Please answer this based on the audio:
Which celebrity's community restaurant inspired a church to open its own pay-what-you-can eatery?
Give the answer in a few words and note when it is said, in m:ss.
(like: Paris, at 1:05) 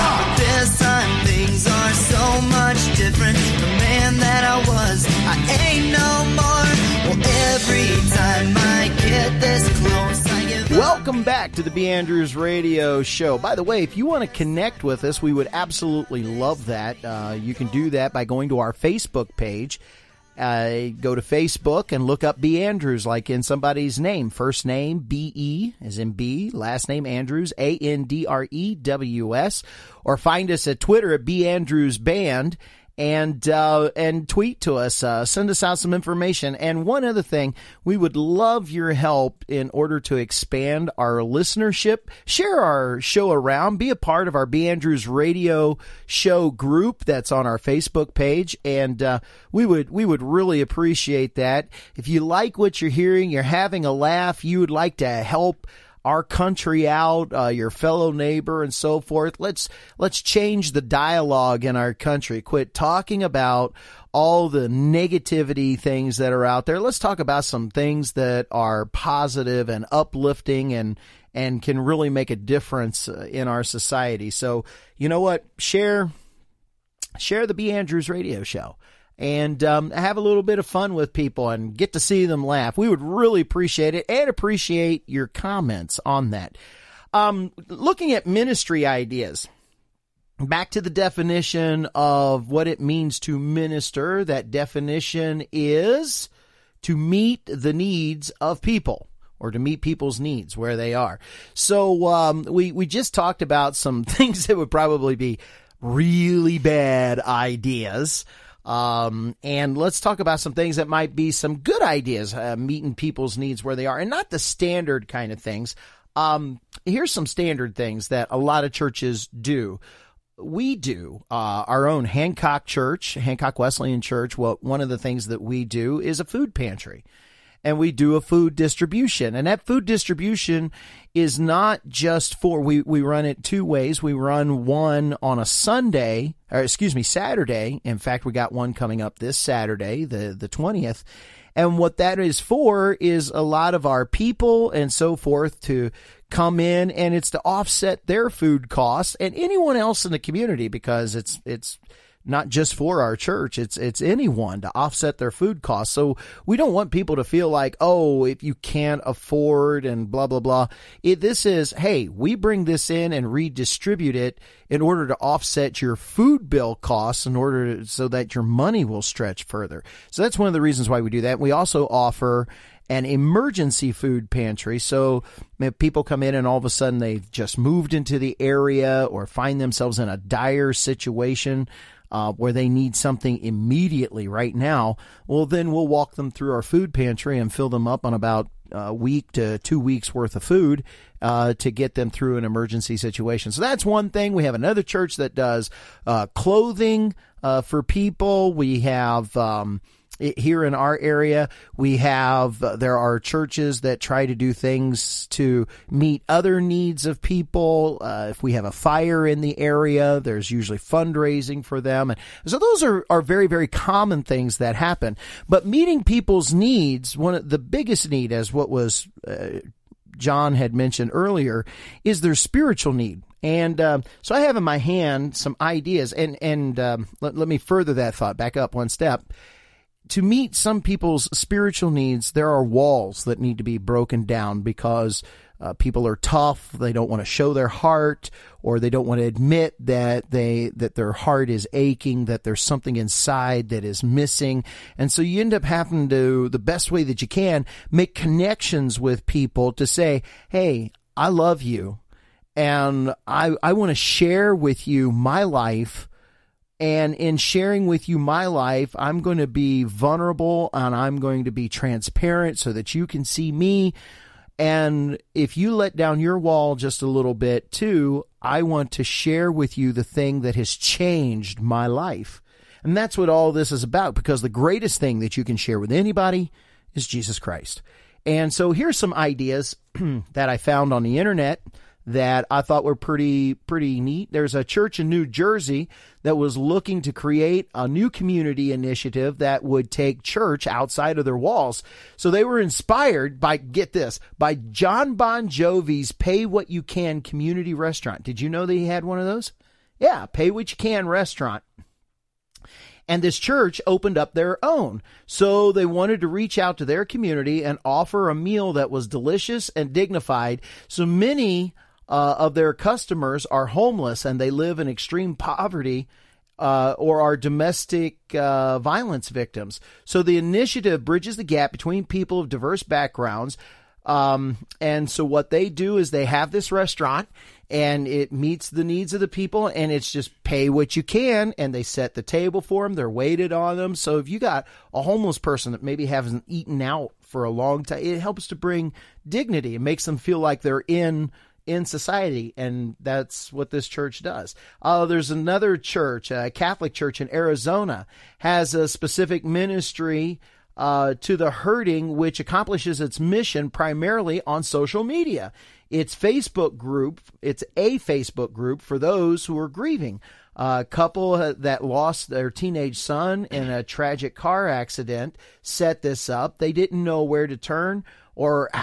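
John Bon Jovi, at 4:54.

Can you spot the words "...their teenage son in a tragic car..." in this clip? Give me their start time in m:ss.
6:02.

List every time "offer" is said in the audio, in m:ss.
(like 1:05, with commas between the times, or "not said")
2:51, 5:07.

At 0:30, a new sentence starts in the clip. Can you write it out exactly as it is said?
Or find us at Twitter at B Andrews Band and uh, and tweet to us, uh, send us out some information.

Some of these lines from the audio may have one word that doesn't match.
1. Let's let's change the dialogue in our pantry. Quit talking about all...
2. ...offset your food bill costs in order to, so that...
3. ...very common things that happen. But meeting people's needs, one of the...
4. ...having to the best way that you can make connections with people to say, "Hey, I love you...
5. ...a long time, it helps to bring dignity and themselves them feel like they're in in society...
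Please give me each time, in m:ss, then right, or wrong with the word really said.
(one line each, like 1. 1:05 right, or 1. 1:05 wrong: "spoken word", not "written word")
1. 0:59 wrong: "country", not "pantry"
2. 2:45 right
3. 3:33 right
4. 4:05 right
5. 5:37 wrong: "makes", not "themselves".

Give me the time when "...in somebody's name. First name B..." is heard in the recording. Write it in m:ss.
0:23.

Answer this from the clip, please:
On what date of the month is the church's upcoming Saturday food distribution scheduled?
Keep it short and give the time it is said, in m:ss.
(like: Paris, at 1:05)
the 20th, at 2:20.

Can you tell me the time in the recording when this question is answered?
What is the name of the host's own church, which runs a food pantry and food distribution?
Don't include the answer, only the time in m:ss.
2:03.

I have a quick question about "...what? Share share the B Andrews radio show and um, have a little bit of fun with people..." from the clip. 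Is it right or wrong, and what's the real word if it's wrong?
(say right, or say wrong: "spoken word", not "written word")
right.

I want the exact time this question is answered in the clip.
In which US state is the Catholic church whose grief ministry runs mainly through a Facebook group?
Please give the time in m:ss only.
5:47.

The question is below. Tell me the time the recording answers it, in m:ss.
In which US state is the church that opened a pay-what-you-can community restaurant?
4:45.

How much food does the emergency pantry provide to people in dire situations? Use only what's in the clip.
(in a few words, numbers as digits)
1 to 2 weeks' worth.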